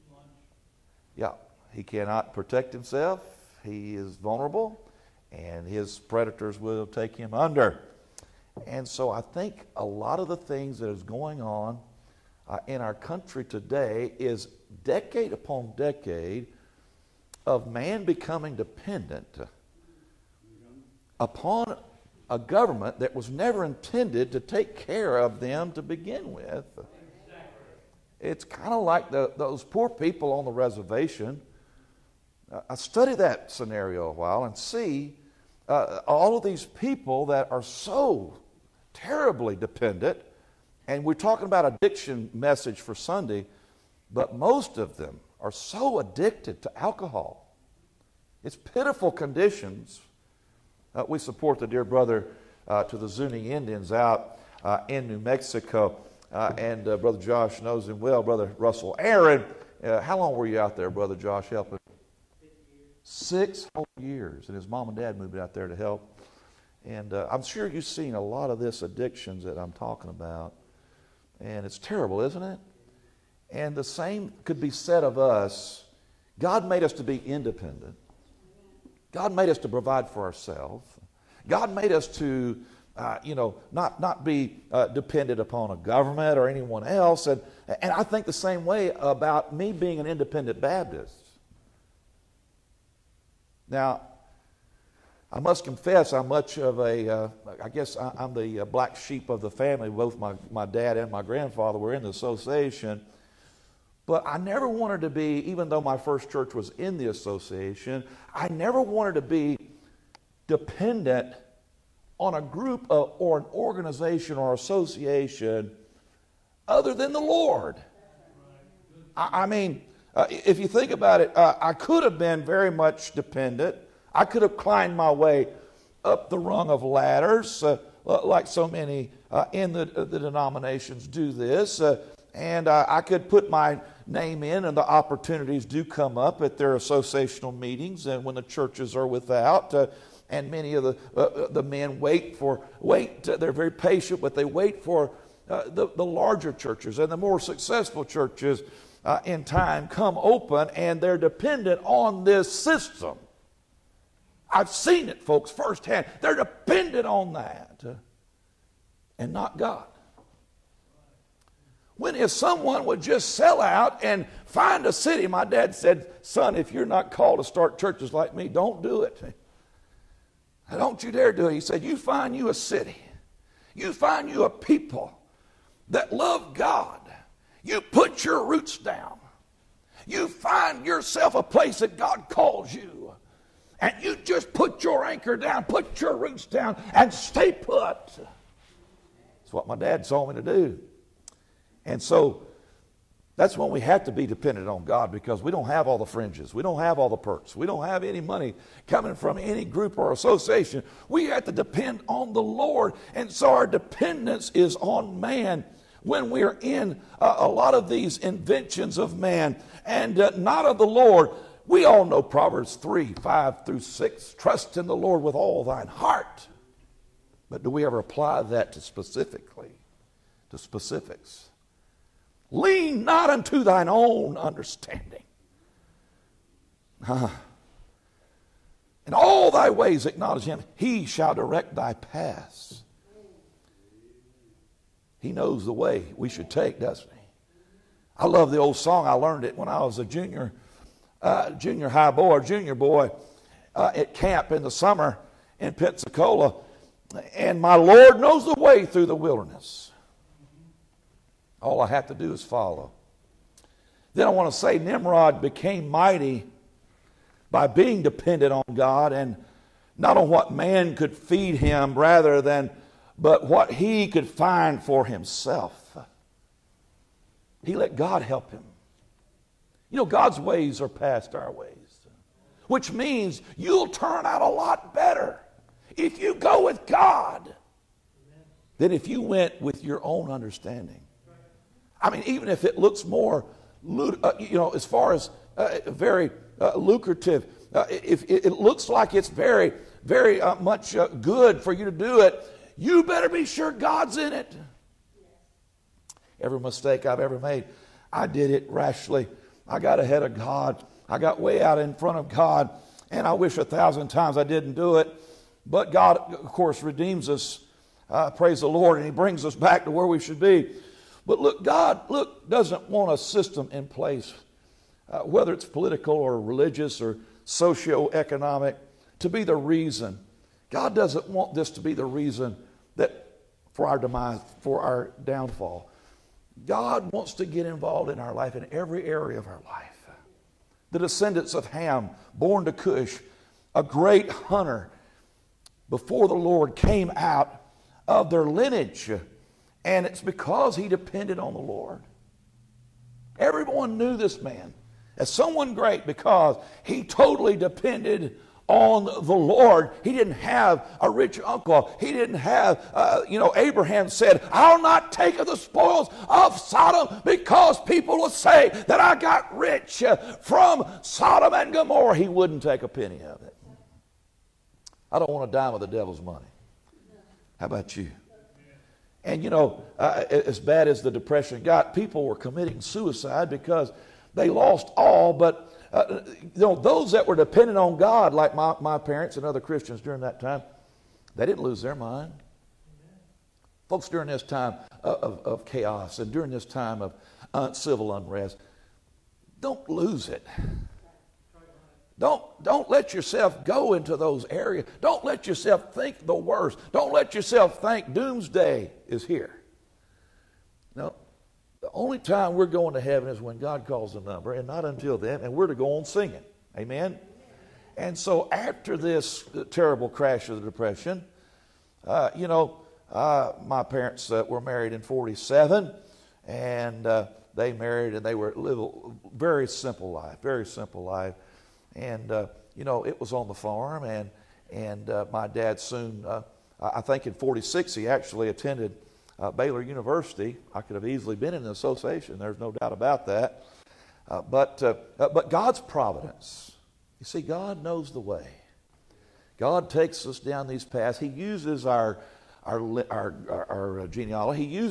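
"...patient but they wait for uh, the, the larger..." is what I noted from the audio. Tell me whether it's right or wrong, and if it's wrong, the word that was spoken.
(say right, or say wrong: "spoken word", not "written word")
right.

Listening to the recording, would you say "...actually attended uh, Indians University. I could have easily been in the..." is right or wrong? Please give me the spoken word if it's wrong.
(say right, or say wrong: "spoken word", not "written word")
wrong: "Baylor", not "Indians".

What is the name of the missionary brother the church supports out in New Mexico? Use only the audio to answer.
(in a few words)
Russell Aaron.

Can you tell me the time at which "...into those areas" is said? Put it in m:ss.
6:33.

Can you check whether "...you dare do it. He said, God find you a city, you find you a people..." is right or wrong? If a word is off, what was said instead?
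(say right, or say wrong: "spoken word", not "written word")
wrong: "You", not "God".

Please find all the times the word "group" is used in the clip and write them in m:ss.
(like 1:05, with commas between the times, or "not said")
1:52, 3:19.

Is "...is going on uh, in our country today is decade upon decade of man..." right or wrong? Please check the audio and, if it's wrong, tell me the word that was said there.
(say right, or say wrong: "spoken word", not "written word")
right.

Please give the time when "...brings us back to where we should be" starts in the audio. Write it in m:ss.
5:09.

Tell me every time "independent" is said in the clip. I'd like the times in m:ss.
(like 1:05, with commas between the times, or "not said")
1:17, 1:30.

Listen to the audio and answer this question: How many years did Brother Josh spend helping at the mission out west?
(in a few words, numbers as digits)
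6.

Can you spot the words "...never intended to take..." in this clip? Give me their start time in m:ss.
0:23.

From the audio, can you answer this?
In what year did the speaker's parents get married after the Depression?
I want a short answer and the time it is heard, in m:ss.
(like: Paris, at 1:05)
1947, at 6:55.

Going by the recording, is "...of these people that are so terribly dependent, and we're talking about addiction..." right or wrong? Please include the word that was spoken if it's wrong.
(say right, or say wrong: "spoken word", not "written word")
right.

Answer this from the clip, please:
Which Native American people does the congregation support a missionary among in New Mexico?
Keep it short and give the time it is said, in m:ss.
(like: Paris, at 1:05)
Zuni, at 0:53.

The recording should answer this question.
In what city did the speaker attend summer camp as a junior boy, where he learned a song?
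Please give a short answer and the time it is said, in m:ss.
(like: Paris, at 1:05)
Pensacola, at 4:05.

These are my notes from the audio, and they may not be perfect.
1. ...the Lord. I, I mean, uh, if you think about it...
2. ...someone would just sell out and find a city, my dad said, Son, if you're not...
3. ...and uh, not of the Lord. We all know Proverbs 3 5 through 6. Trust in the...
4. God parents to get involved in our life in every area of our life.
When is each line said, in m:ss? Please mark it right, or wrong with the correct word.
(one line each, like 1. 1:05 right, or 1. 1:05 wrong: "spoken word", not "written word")
1. 1:57 right
2. 2:42 right
3. 3:29 right
4. 5:26 wrong: "wants", not "parents".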